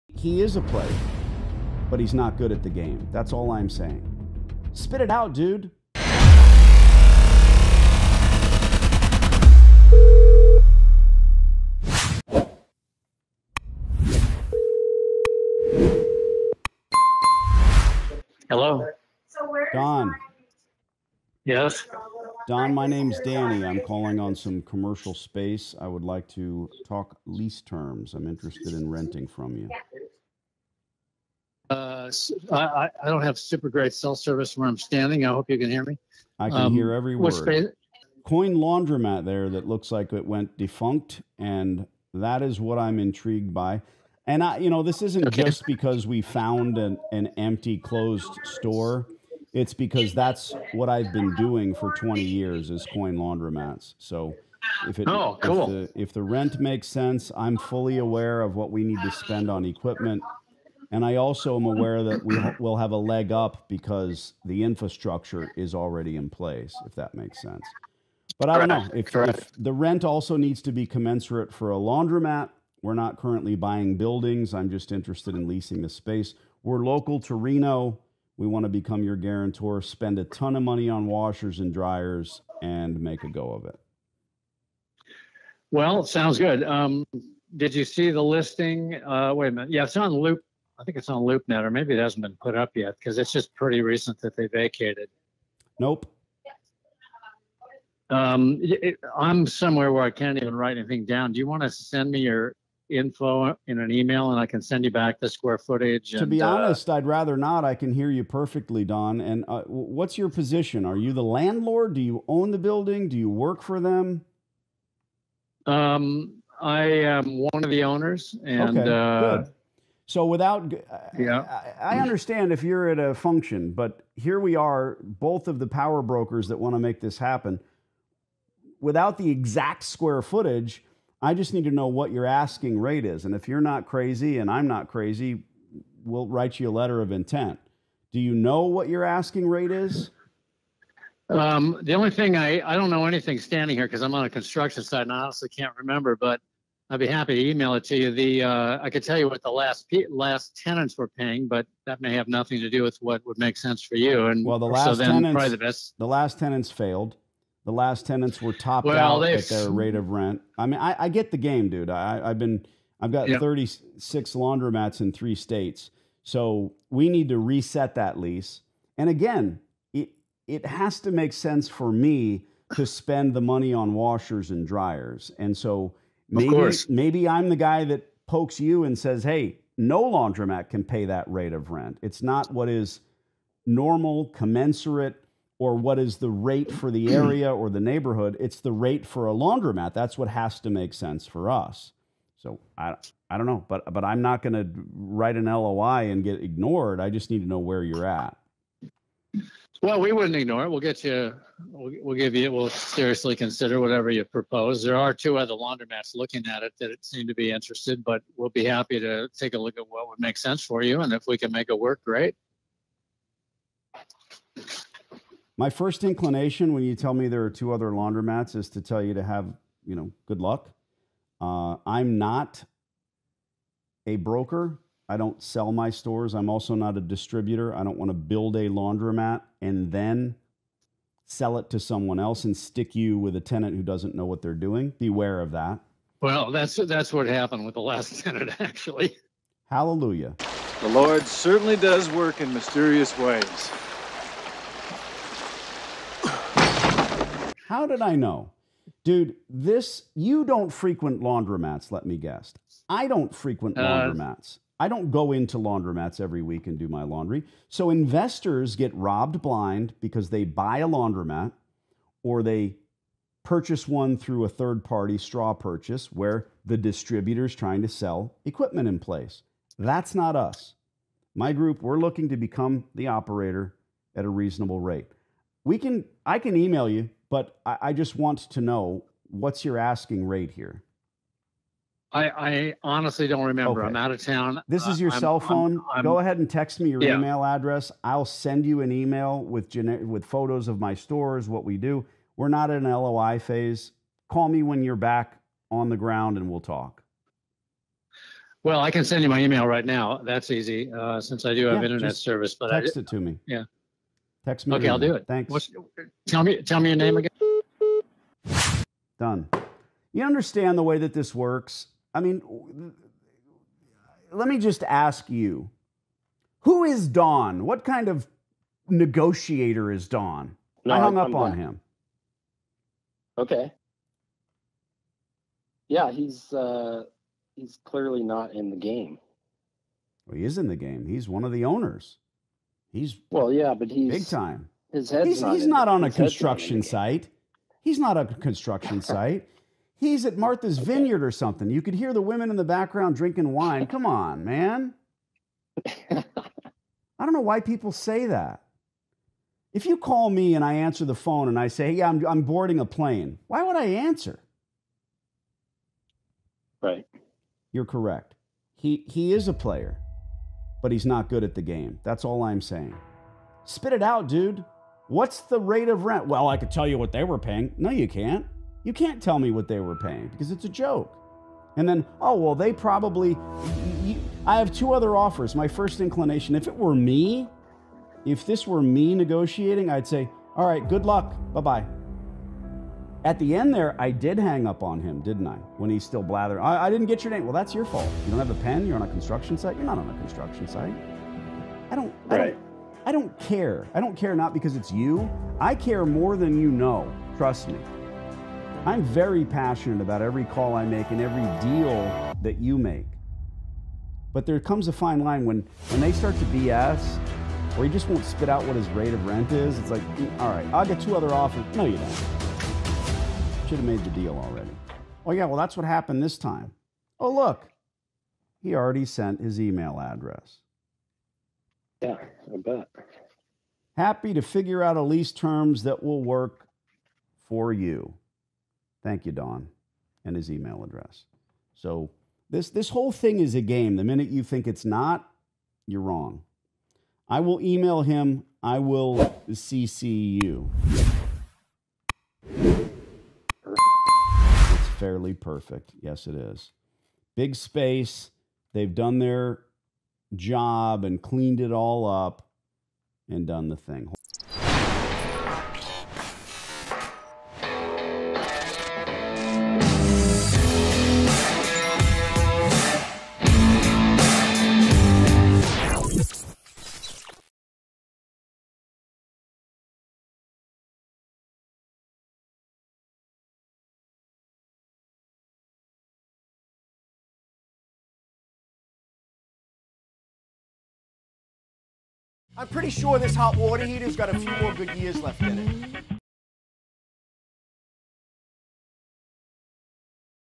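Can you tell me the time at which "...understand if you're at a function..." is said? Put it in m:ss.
2:02.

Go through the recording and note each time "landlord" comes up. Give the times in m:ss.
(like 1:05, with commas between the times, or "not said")
1:51.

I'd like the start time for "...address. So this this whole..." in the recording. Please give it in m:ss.
7:10.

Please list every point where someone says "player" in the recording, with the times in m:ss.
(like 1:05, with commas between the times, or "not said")
0:00, 5:59.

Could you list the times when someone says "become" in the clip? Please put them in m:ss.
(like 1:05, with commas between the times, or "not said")
1:18, 4:32.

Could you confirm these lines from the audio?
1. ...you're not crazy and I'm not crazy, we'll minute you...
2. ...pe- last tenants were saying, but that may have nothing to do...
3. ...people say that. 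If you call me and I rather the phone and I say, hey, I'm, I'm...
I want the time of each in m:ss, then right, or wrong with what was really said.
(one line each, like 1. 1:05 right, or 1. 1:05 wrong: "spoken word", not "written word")
1. 2:13 wrong: "write", not "minute"
2. 2:29 wrong: "paying", not "saying"
3. 5:47 wrong: "answer", not "rather".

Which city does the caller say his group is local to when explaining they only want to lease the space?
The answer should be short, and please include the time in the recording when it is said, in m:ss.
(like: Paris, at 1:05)
Reno, at 1:17.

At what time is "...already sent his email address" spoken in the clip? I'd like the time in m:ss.
6:58.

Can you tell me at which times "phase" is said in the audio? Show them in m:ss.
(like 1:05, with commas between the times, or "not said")
4:53.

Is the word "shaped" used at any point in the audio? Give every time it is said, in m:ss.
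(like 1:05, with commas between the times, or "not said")
not said.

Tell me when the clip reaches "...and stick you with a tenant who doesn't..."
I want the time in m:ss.
3:52.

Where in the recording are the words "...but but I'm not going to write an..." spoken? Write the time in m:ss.
3:13.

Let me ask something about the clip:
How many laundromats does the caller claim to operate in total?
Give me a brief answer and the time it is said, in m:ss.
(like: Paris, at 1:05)
36, at 2:43.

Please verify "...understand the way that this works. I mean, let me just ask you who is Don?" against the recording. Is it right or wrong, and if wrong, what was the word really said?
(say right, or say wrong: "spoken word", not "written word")
right.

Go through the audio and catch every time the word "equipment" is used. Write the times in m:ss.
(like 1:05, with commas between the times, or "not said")
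0:59, 4:28.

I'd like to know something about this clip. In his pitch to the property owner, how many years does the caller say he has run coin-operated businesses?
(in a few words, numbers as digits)
20.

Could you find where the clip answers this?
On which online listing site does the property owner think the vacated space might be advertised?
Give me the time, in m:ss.
1:31.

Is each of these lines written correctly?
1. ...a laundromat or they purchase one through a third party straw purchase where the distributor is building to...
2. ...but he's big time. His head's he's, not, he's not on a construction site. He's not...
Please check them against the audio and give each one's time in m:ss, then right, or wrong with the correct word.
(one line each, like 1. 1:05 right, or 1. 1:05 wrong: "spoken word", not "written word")
1. 4:20 wrong: "trying", not "building"
2. 5:33 right.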